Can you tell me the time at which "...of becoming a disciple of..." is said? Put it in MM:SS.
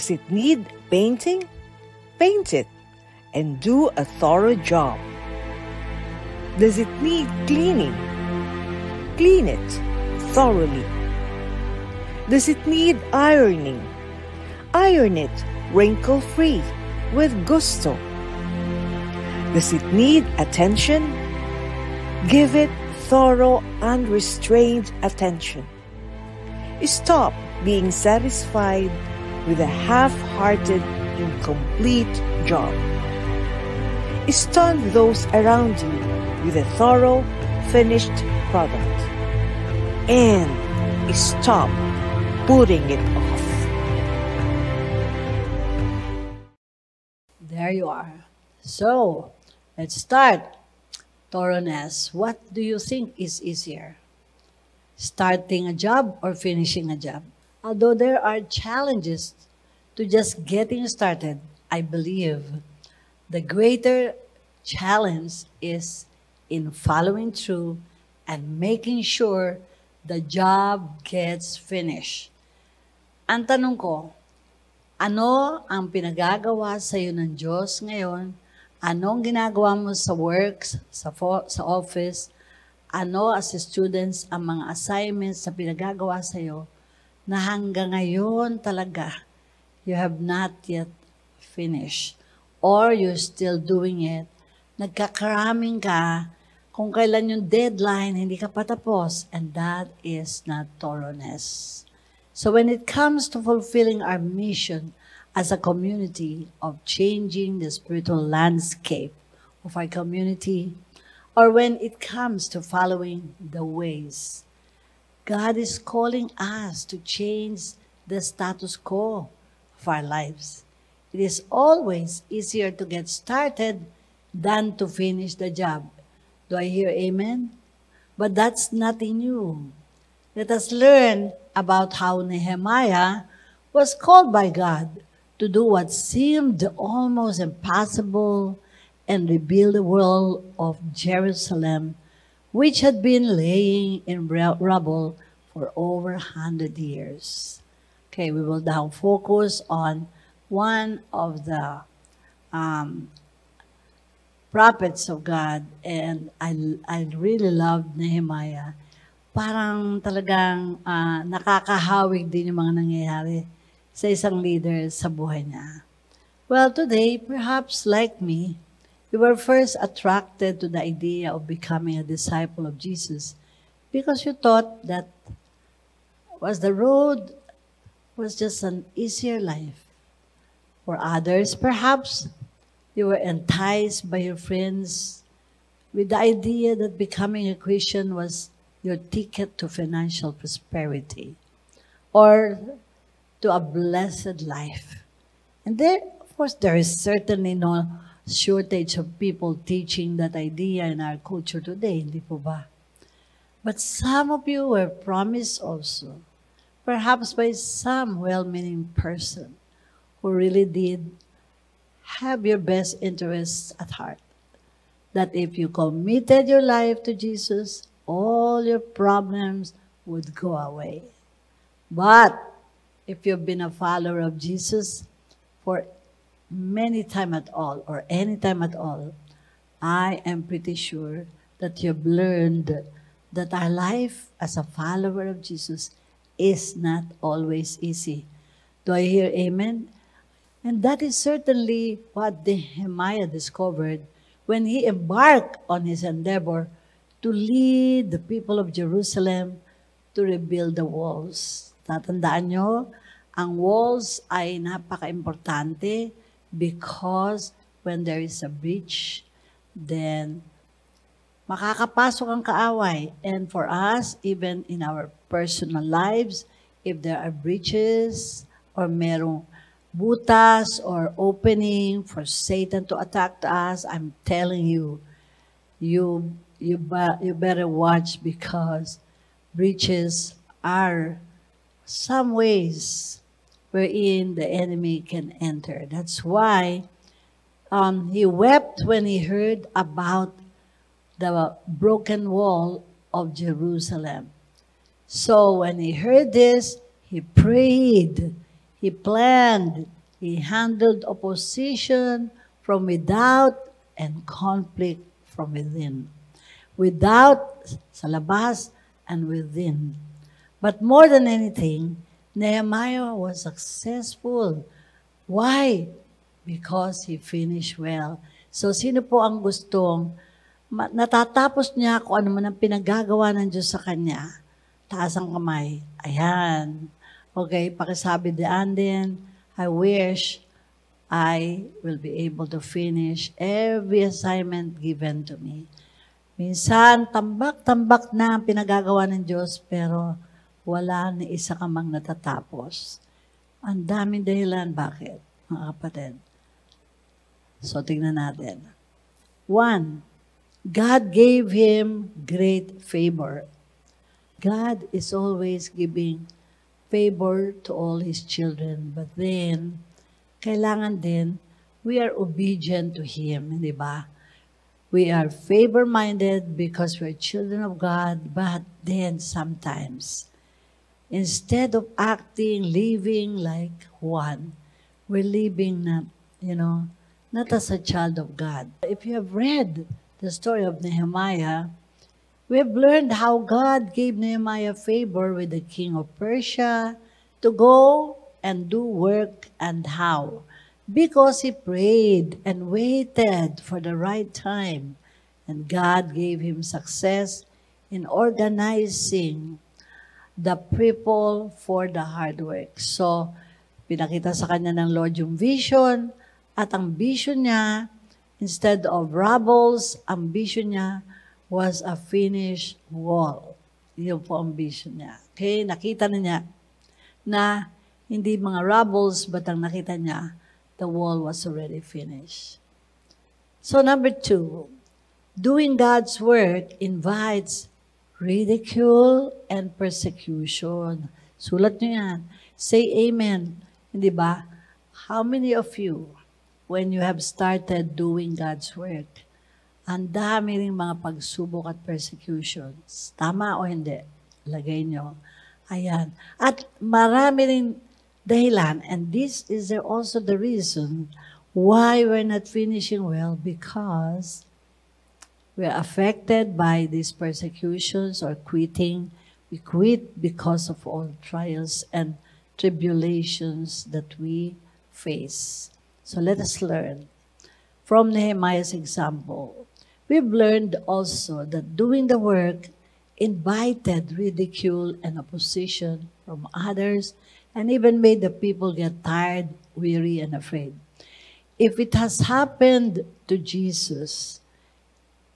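02:51.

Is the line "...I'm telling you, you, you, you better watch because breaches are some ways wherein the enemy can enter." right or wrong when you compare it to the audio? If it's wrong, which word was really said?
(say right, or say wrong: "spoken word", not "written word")
right.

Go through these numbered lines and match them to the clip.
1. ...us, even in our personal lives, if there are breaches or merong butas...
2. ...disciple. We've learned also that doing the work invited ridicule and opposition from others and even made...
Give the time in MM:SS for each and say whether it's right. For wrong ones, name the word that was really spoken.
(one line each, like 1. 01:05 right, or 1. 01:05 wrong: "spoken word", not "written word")
1. 04:23 right
2. 07:48 wrong: "example", not "disciple".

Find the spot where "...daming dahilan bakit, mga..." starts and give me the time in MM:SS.
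05:43.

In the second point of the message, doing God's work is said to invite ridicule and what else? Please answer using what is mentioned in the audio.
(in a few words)
persecution.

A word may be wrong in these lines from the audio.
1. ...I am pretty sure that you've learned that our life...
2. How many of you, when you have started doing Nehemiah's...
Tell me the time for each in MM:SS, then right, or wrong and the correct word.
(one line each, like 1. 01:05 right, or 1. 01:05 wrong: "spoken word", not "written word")
1. 03:49 right
2. 07:15 wrong: "God", not "Nehemiah".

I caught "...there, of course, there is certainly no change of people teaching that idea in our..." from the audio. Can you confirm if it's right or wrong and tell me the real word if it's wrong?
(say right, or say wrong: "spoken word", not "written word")
wrong: "shortage", not "change".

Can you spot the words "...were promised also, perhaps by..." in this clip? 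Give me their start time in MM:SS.
03:24.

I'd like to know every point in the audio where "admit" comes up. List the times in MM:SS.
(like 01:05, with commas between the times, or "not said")
not said.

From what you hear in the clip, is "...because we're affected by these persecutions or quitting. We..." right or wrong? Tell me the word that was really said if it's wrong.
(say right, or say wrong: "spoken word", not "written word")
right.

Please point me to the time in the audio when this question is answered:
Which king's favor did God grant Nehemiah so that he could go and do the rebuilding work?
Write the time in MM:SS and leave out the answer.
06:25.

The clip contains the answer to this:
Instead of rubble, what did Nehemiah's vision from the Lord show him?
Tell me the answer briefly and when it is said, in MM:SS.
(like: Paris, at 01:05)
a finished wall, at 06:51.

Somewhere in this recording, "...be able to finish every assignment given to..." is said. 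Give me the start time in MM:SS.
05:32.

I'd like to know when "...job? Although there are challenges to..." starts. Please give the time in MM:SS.
00:56.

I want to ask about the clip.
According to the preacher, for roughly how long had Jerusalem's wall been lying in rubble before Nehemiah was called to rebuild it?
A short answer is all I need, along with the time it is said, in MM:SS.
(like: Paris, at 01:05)
over 100 years, at 02:25.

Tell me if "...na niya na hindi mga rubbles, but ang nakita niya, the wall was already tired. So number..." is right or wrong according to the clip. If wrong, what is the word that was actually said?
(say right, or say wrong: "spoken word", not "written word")
wrong: "finished", not "tired".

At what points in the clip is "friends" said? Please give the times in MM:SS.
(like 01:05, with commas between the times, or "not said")
03:04.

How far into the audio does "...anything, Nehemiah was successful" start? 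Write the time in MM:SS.
05:11.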